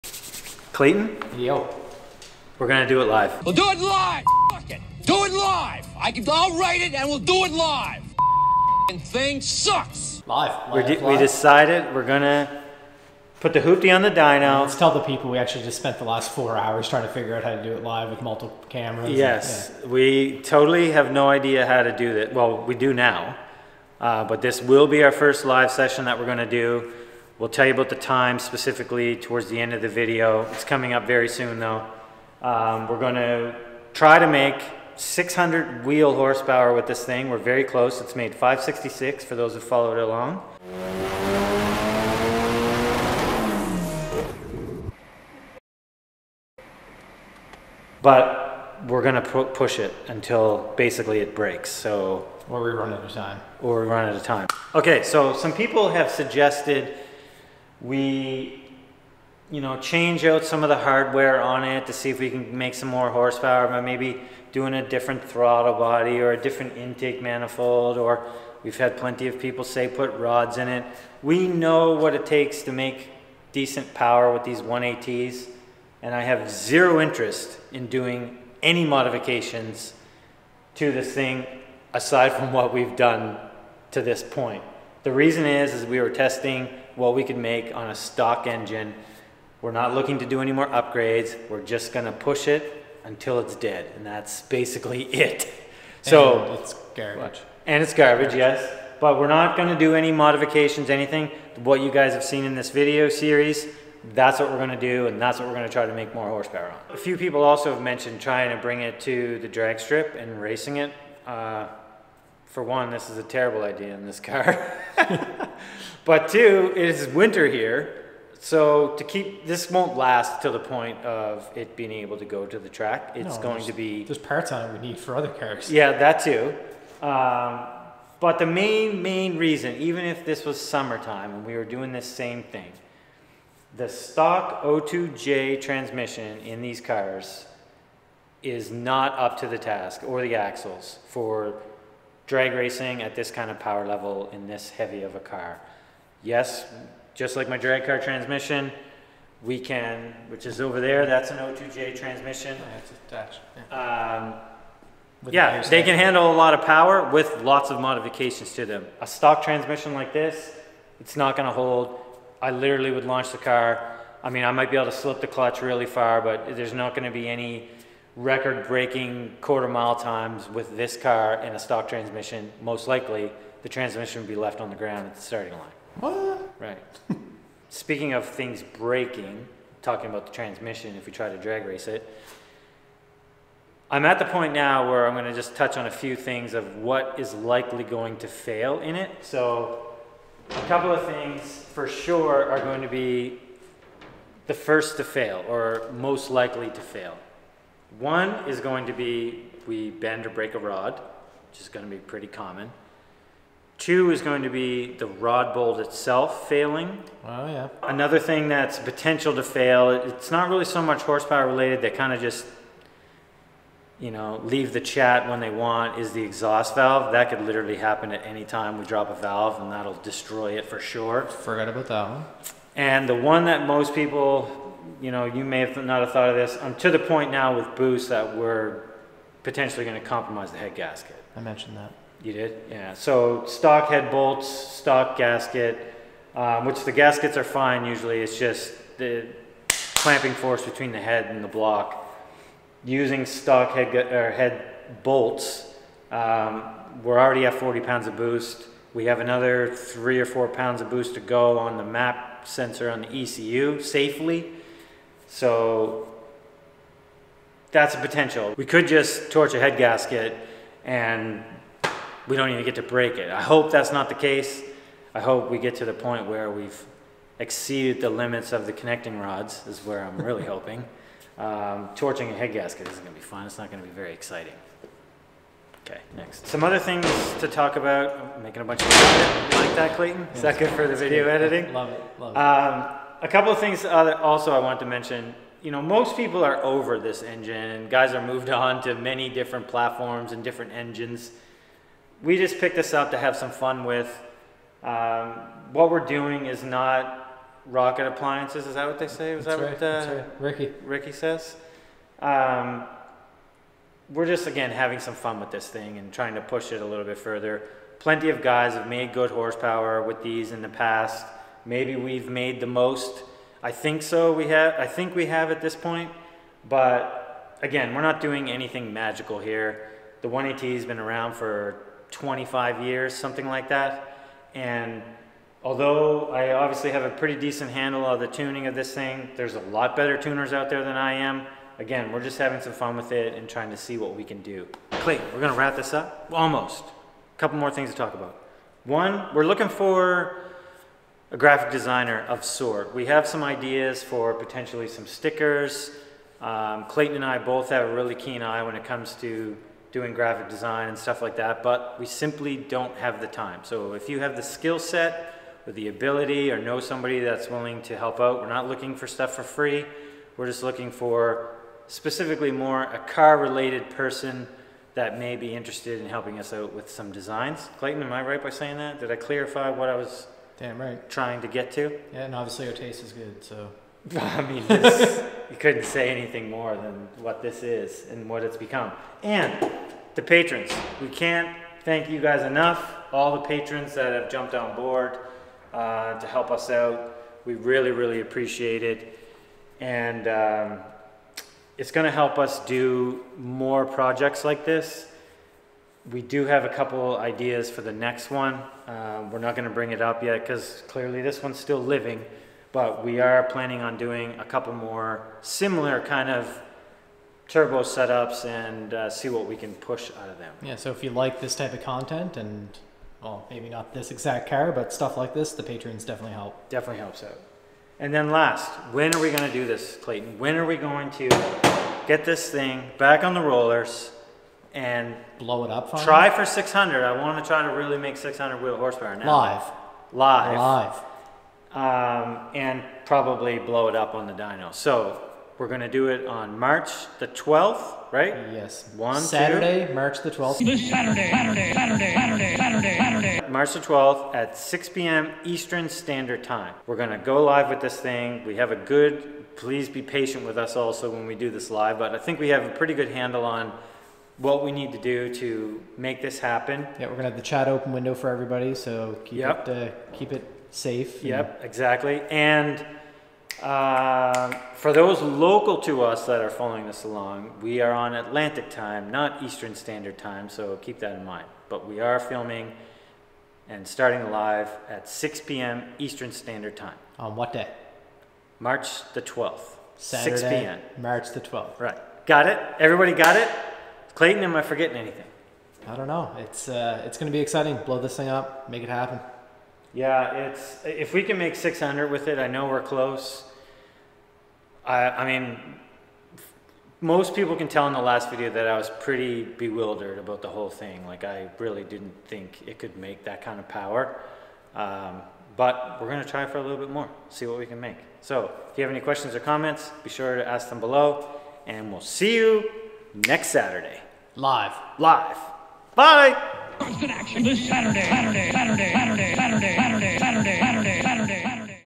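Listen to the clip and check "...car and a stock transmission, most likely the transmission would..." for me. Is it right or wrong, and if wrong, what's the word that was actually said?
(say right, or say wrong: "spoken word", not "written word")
right.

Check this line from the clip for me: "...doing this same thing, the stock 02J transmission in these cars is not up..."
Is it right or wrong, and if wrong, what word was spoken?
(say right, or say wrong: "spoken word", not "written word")
right.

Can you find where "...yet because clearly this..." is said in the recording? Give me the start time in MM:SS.
06:40.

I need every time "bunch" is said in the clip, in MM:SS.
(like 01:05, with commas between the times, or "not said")
04:38.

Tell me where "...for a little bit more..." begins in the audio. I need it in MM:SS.
08:26.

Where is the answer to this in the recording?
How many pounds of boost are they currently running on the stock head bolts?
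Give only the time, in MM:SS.
04:07.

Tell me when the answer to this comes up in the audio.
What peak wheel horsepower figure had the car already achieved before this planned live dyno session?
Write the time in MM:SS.
00:38.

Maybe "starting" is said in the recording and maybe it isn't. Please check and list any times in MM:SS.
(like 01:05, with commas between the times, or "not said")
02:55, 07:53.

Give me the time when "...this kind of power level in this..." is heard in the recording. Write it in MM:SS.
02:23.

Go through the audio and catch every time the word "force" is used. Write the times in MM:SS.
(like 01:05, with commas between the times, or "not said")
04:00.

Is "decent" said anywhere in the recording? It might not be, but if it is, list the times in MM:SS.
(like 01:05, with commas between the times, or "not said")
01:13, 05:27.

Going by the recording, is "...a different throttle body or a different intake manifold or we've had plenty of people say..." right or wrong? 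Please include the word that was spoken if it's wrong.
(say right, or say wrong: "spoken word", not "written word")
right.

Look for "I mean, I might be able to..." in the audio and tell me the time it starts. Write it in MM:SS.
02:44.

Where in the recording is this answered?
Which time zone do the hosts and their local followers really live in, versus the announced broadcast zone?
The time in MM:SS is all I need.
07:48.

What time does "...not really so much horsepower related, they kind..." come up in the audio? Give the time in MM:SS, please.
03:30.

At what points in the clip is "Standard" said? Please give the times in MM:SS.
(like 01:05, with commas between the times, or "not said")
07:25, 07:49, 07:56.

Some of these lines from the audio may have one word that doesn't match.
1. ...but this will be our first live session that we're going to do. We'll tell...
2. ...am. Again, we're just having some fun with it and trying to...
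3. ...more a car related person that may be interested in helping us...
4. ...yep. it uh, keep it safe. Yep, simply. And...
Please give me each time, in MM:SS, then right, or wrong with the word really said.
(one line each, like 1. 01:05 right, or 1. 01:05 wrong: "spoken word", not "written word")
1. 00:24 right
2. 05:31 right
3. 06:02 right
4. 07:39 wrong: "exactly", not "simply".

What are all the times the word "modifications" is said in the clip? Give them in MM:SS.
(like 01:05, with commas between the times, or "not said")
01:18, 01:40, 02:37.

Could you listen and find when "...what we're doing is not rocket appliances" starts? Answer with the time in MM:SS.
04:55.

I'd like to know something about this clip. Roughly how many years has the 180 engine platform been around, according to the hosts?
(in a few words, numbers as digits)
25 years.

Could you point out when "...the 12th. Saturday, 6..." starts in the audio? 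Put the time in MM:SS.
07:59.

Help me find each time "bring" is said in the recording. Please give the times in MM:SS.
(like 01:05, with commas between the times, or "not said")
01:48, 06:39.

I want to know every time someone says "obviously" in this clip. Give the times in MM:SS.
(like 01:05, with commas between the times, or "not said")
05:26, 06:12.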